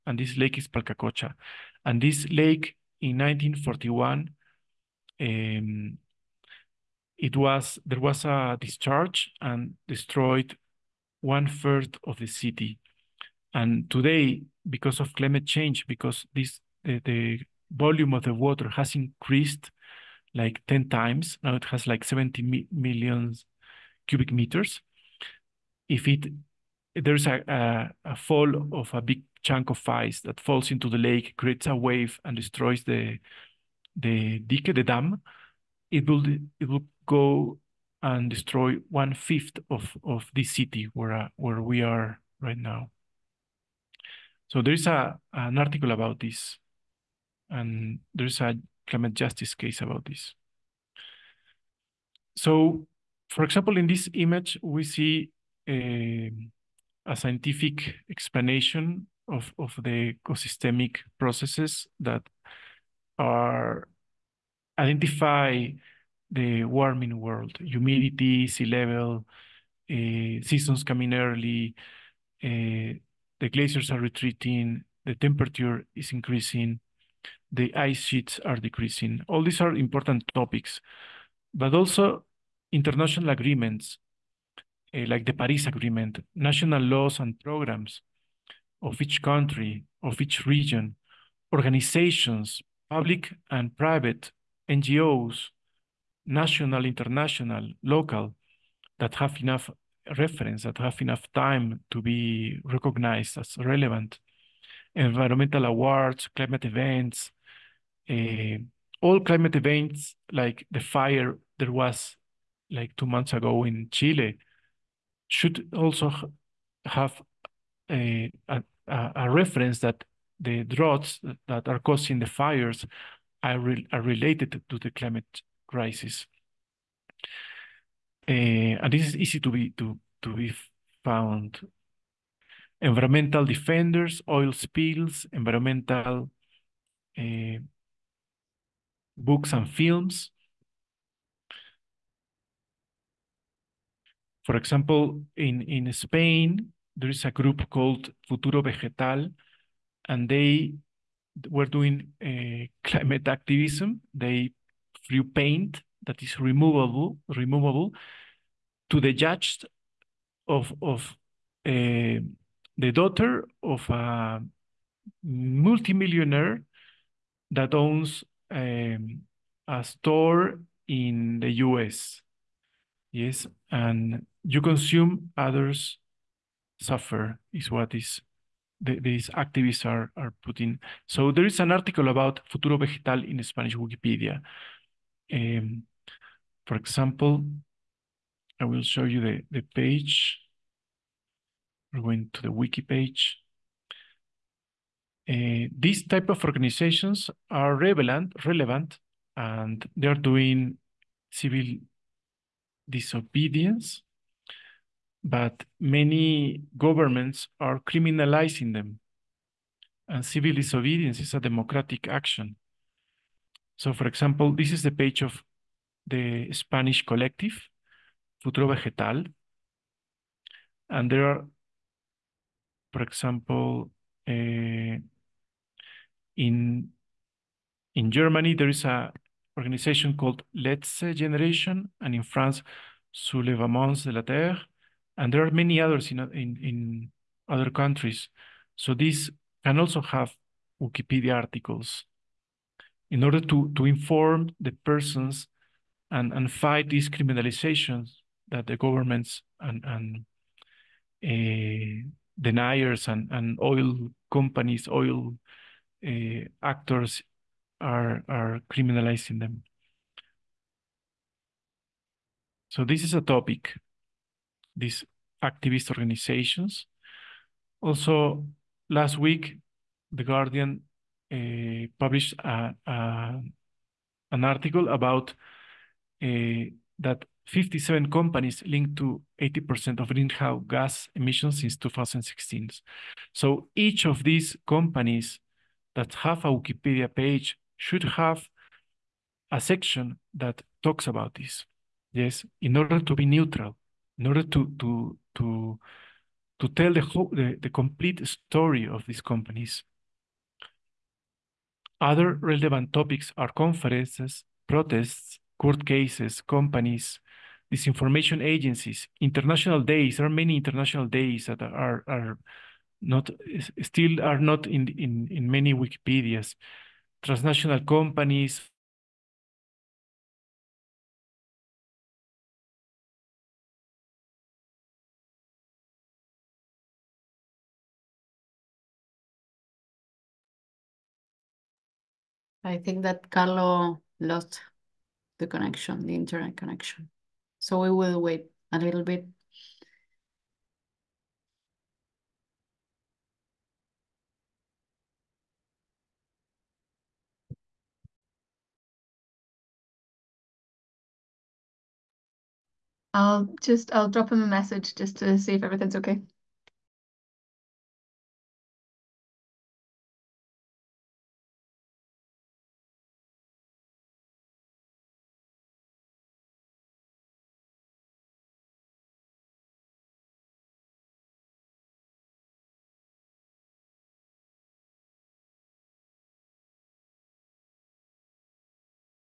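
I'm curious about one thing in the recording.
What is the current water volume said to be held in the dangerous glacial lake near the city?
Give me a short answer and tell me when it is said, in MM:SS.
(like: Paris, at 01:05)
70 million cubic meters, at 00:22.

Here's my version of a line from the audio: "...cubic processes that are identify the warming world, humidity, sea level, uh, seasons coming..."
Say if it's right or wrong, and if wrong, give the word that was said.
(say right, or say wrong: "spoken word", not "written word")
wrong: "ecosystemic", not "cubic".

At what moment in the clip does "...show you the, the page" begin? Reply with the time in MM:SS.
03:08.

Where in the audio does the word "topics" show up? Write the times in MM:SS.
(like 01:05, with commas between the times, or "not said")
01:20, 04:23, 05:02.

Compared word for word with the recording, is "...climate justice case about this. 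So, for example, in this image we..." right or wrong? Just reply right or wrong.
right.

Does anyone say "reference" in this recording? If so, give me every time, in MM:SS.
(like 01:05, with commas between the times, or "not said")
01:40, 01:59.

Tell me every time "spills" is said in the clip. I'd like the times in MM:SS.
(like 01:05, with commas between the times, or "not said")
02:14.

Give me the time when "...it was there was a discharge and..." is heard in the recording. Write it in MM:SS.
00:07.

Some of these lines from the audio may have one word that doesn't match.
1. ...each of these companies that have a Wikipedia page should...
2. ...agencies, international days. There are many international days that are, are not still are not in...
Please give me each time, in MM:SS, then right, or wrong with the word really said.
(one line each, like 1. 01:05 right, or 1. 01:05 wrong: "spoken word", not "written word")
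1. 04:43 right
2. 05:08 right.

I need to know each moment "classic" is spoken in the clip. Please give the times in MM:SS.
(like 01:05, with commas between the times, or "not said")
not said.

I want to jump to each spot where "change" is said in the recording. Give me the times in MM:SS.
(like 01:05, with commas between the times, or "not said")
00:15.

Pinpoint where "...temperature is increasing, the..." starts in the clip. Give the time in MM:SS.
01:15.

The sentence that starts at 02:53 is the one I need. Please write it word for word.
Yes, and you consume, others suffer is what is the, these activists are, are putting.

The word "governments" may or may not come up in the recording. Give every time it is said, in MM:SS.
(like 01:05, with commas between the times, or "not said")
03:26, 04:08.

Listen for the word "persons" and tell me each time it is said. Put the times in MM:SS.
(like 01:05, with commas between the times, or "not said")
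04:04.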